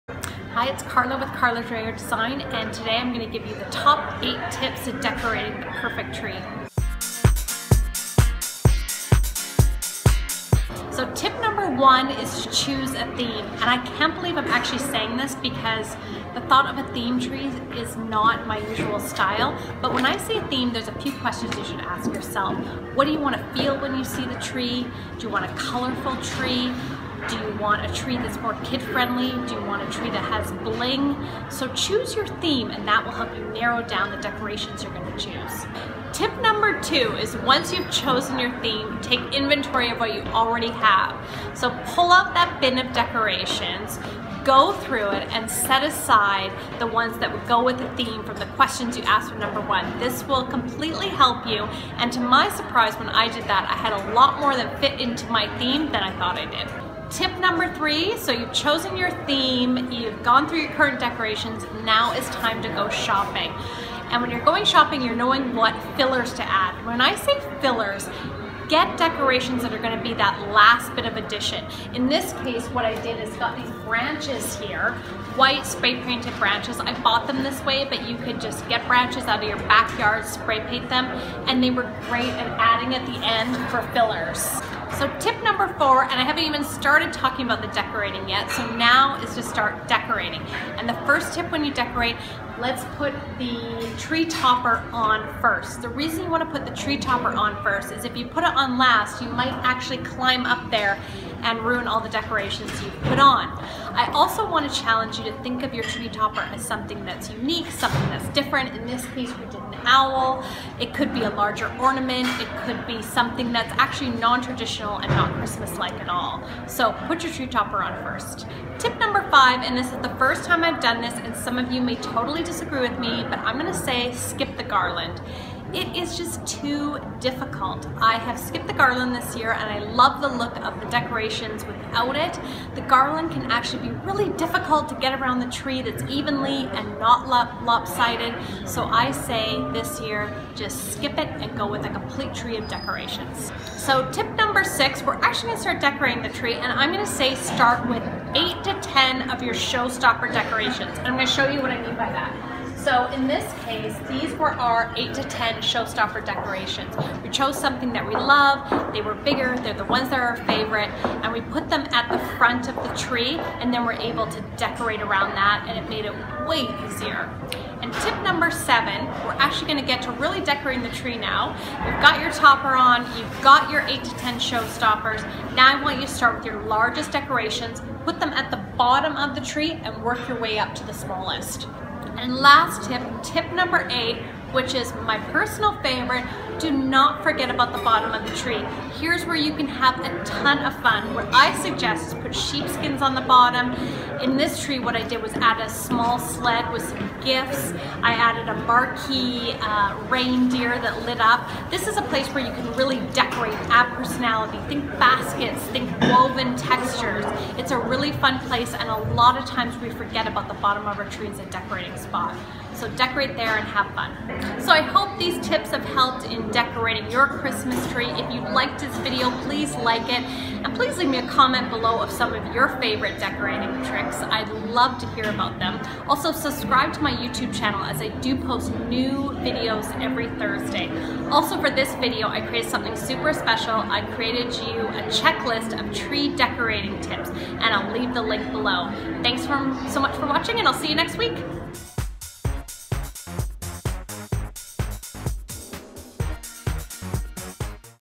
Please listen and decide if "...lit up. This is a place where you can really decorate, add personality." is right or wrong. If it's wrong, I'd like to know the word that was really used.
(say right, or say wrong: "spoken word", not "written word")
right.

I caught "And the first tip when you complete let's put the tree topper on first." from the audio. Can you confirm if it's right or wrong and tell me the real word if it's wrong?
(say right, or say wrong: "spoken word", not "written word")
wrong: "decorate", not "complete".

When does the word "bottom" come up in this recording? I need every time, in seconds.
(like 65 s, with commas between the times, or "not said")
178 s, 187 s, 193 s, 210 s.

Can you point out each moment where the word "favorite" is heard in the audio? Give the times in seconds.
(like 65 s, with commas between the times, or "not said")
160 s, 185 s, 222 s.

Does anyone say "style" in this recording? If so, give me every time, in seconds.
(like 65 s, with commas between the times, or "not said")
18 s.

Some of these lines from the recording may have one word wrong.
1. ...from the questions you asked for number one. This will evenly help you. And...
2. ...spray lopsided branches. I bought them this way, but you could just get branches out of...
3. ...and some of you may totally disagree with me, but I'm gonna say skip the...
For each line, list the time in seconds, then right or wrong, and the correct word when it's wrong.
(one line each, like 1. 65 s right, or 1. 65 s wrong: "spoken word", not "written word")
1. 48 s wrong: "completely", not "evenly"
2. 75 s wrong: "painted", not "lopsided"
3. 121 s right.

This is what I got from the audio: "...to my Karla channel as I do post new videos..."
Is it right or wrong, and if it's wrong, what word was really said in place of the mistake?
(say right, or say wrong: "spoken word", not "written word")
wrong: "YouTube", not "Karla".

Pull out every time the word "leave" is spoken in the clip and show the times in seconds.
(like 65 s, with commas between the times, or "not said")
220 s, 237 s.